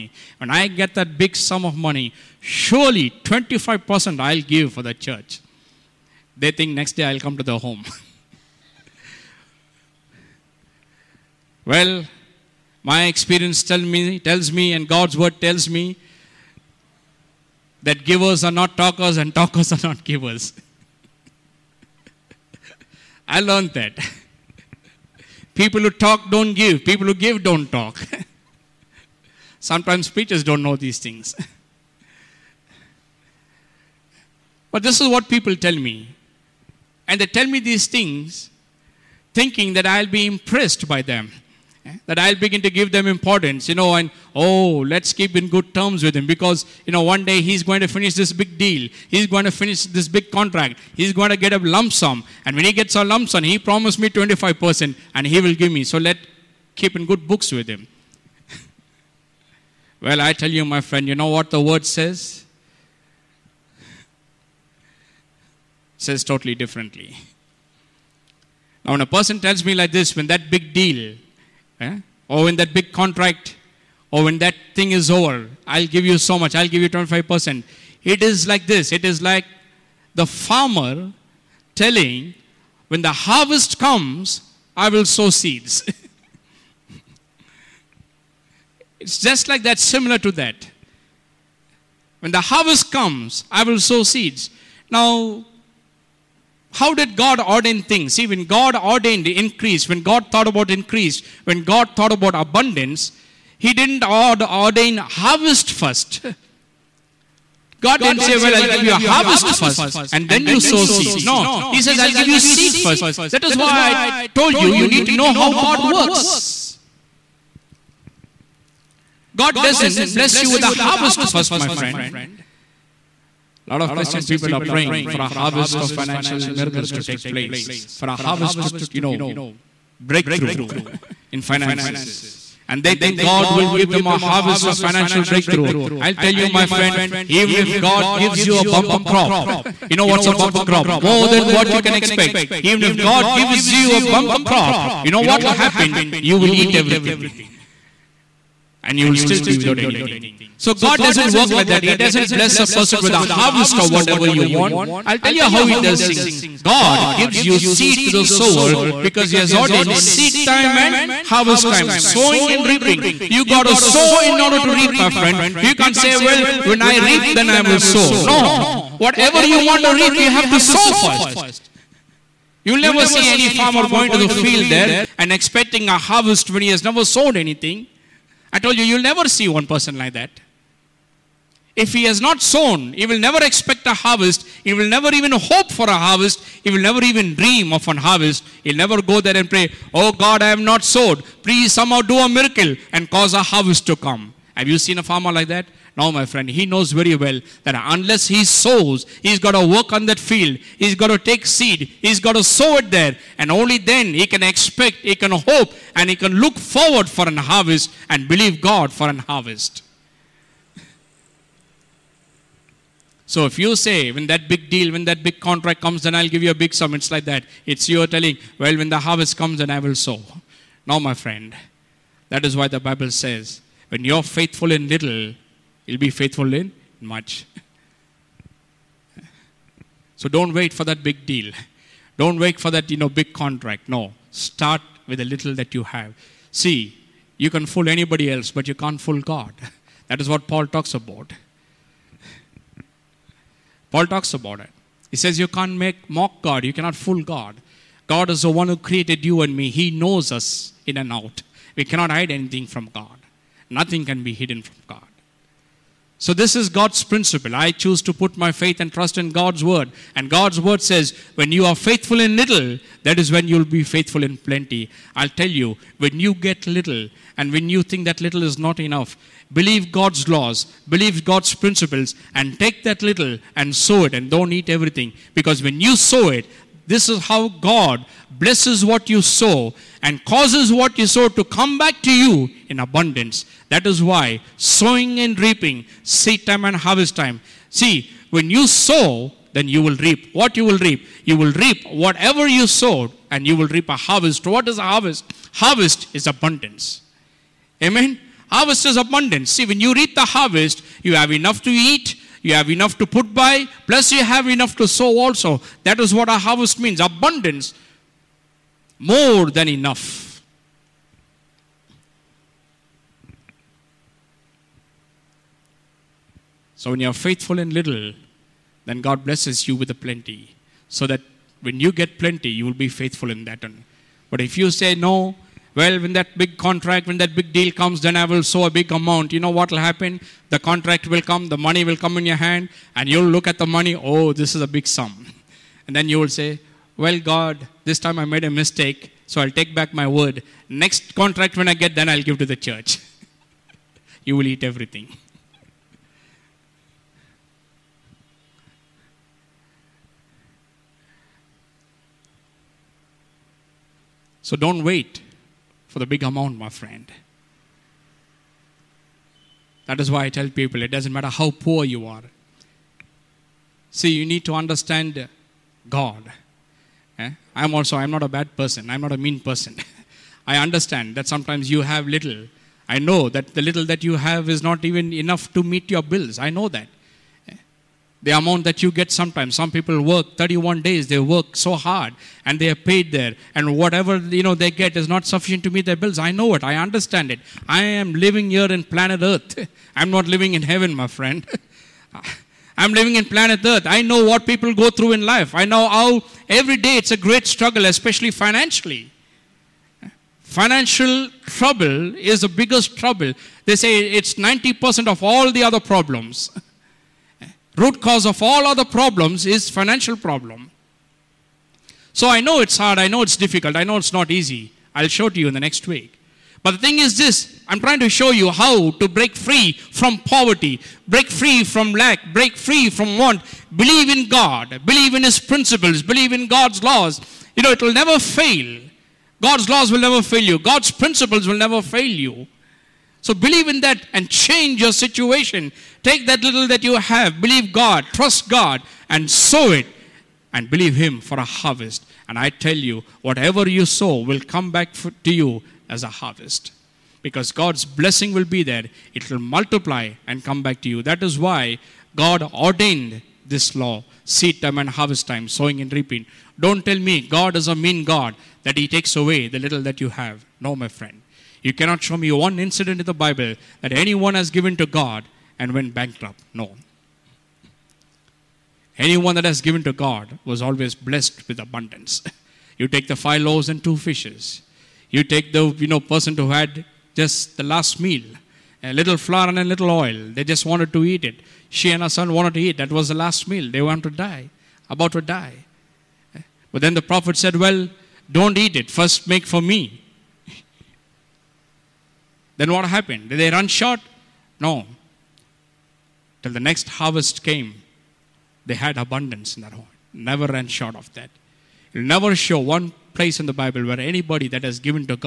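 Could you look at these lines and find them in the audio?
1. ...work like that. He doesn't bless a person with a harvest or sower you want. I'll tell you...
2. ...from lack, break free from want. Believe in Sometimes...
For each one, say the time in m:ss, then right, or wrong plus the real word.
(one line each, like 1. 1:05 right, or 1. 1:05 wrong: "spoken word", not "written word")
1. 2:31 wrong: "whatever", not "sower"
2. 7:01 wrong: "God", not "Sometimes".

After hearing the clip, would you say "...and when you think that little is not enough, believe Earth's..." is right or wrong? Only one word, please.
wrong.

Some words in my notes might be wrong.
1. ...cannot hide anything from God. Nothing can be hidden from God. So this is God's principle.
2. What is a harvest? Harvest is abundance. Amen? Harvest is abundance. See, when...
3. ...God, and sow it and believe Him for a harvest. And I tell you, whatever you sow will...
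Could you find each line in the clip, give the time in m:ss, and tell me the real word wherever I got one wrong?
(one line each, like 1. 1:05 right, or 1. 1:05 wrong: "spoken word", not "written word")
1. 4:11 right
2. 4:54 right
3. 7:18 right.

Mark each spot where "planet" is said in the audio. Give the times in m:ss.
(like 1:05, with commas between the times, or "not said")
6:28, 6:33.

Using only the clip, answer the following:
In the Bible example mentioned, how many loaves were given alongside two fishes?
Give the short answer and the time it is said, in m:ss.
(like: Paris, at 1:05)
5, at 7:53.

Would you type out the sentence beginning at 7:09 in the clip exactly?
God's laws will never fail you.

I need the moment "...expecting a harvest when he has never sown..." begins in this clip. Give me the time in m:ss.
2:55.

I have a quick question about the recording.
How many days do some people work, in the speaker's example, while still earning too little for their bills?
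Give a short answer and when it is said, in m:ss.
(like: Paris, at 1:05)
31, at 6:20.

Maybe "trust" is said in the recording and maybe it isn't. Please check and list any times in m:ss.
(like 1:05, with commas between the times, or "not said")
4:18, 7:18.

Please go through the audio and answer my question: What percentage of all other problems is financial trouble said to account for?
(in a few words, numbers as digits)
90%.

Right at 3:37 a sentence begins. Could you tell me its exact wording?
It's you telling, well, when the harvest comes, then I will sow.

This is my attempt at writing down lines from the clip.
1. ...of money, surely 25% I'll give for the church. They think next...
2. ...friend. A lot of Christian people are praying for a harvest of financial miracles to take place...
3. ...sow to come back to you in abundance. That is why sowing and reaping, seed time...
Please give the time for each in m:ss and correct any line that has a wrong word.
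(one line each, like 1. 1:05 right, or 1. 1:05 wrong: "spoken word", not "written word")
1. 0:01 right
2. 2:01 right
3. 4:41 right.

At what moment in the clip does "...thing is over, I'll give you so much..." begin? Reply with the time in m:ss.
1:14.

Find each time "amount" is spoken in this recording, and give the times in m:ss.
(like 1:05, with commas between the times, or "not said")
5:28, 5:56, 6:18.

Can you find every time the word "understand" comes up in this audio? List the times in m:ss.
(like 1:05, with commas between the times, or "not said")
6:04, 6:10, 6:26.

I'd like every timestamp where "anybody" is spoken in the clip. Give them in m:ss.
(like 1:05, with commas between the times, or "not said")
3:57, 8:23.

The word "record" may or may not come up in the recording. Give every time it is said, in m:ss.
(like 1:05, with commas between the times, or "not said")
not said.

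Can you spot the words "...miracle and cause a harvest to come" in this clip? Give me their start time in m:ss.
3:12.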